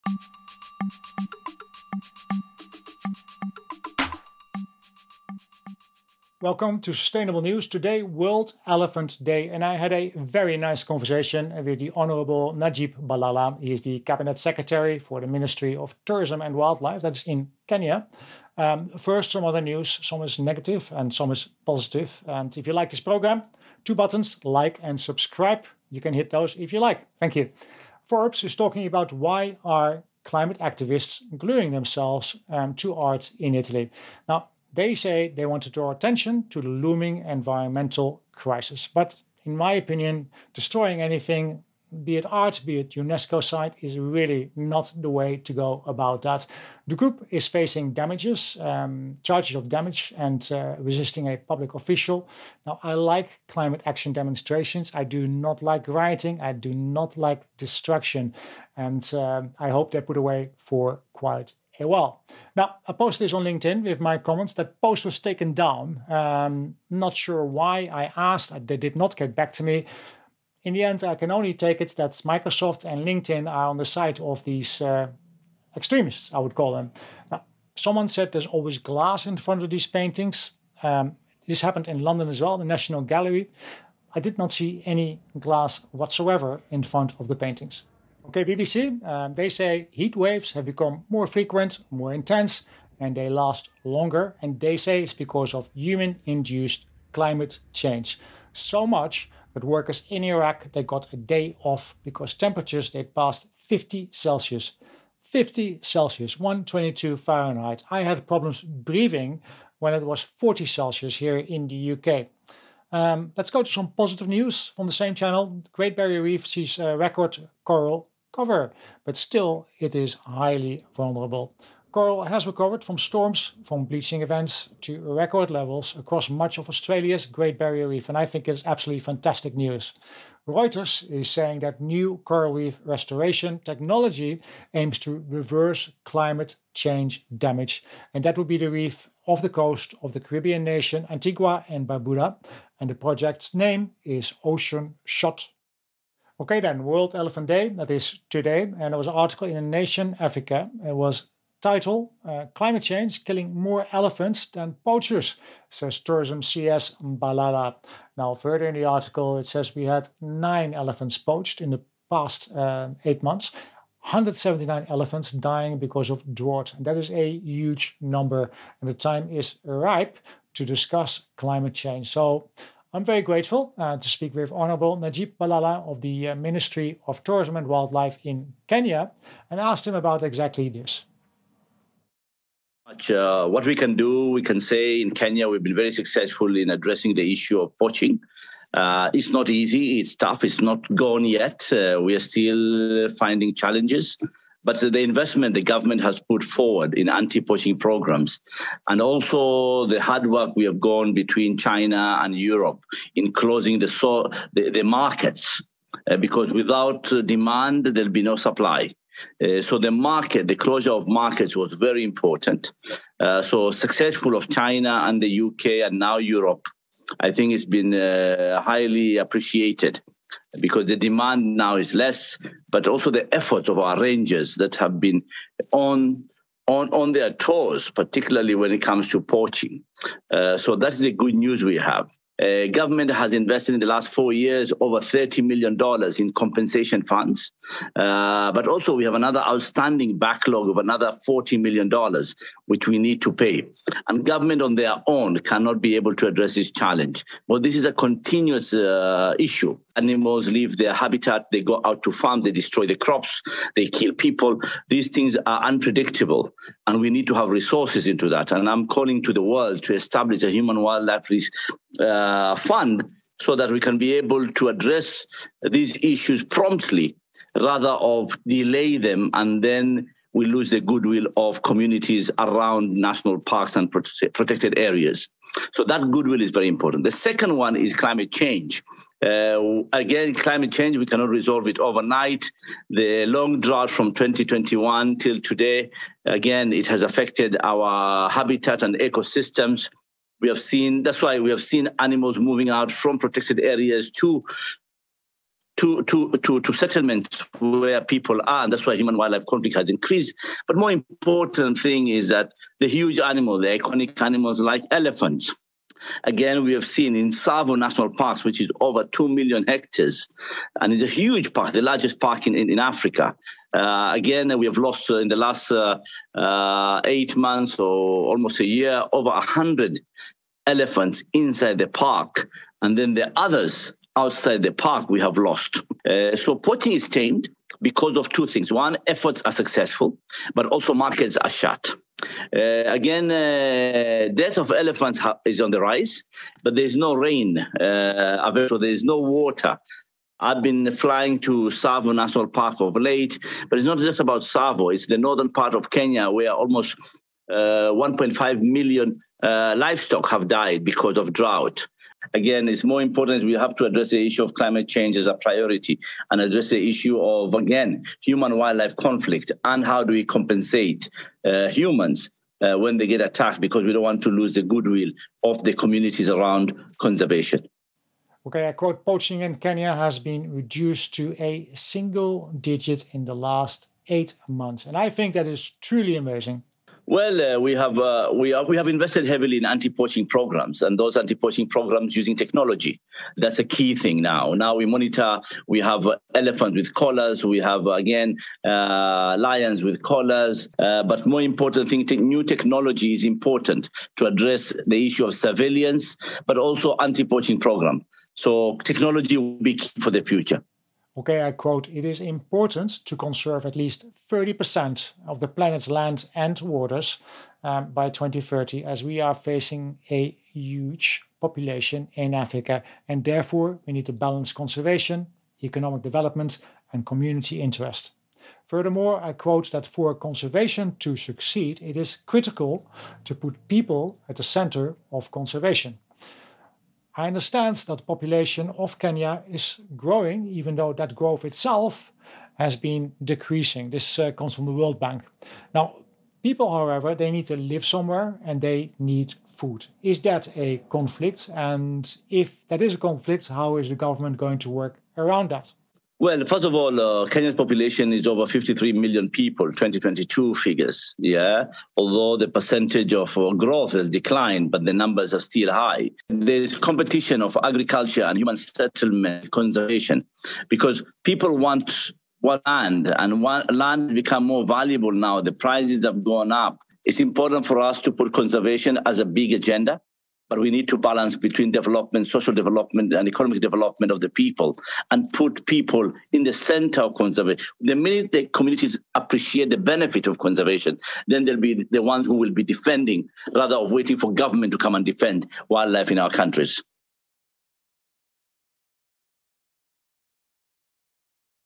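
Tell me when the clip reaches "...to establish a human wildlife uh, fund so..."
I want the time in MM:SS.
04:19.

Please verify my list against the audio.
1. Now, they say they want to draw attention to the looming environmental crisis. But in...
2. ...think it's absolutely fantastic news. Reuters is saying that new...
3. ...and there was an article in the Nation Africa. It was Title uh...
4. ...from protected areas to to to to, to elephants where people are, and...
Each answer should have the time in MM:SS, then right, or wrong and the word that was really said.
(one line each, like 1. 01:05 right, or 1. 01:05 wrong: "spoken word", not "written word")
1. 00:34 right
2. 02:08 right
3. 02:28 right
4. 04:52 wrong: "settlements", not "elephants".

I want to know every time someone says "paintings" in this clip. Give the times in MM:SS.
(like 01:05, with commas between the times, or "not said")
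01:19, 01:27.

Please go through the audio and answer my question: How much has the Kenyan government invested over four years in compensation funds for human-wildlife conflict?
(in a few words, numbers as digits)
$30 million.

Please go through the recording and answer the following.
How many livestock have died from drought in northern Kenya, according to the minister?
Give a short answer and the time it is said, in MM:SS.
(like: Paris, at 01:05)
1.5 million, at 05:47.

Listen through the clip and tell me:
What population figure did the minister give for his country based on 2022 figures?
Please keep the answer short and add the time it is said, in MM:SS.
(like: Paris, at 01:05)
over 53 million, at 07:28.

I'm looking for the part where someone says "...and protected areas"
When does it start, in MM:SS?
04:33.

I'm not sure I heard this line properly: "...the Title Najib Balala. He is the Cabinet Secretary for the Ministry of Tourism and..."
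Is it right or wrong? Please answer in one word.
wrong.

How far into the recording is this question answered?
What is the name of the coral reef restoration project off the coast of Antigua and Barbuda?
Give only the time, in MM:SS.
02:24.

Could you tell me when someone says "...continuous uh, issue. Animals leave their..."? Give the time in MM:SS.
04:07.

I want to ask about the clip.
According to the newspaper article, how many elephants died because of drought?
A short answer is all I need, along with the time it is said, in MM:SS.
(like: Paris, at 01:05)
179, at 02:44.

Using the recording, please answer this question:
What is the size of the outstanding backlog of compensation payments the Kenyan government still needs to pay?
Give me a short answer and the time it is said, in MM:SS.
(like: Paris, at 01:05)
$40 million, at 04:01.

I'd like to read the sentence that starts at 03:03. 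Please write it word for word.
Uh, what we can do, we can say in Kenya, we've been very successful in addressing the issue of poaching.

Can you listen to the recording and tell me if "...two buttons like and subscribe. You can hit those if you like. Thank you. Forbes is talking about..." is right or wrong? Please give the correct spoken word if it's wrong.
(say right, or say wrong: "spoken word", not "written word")
right.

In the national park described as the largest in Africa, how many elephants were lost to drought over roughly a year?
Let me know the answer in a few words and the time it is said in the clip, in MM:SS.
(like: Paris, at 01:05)
over 100, at 05:19.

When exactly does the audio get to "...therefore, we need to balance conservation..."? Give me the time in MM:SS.
06:53.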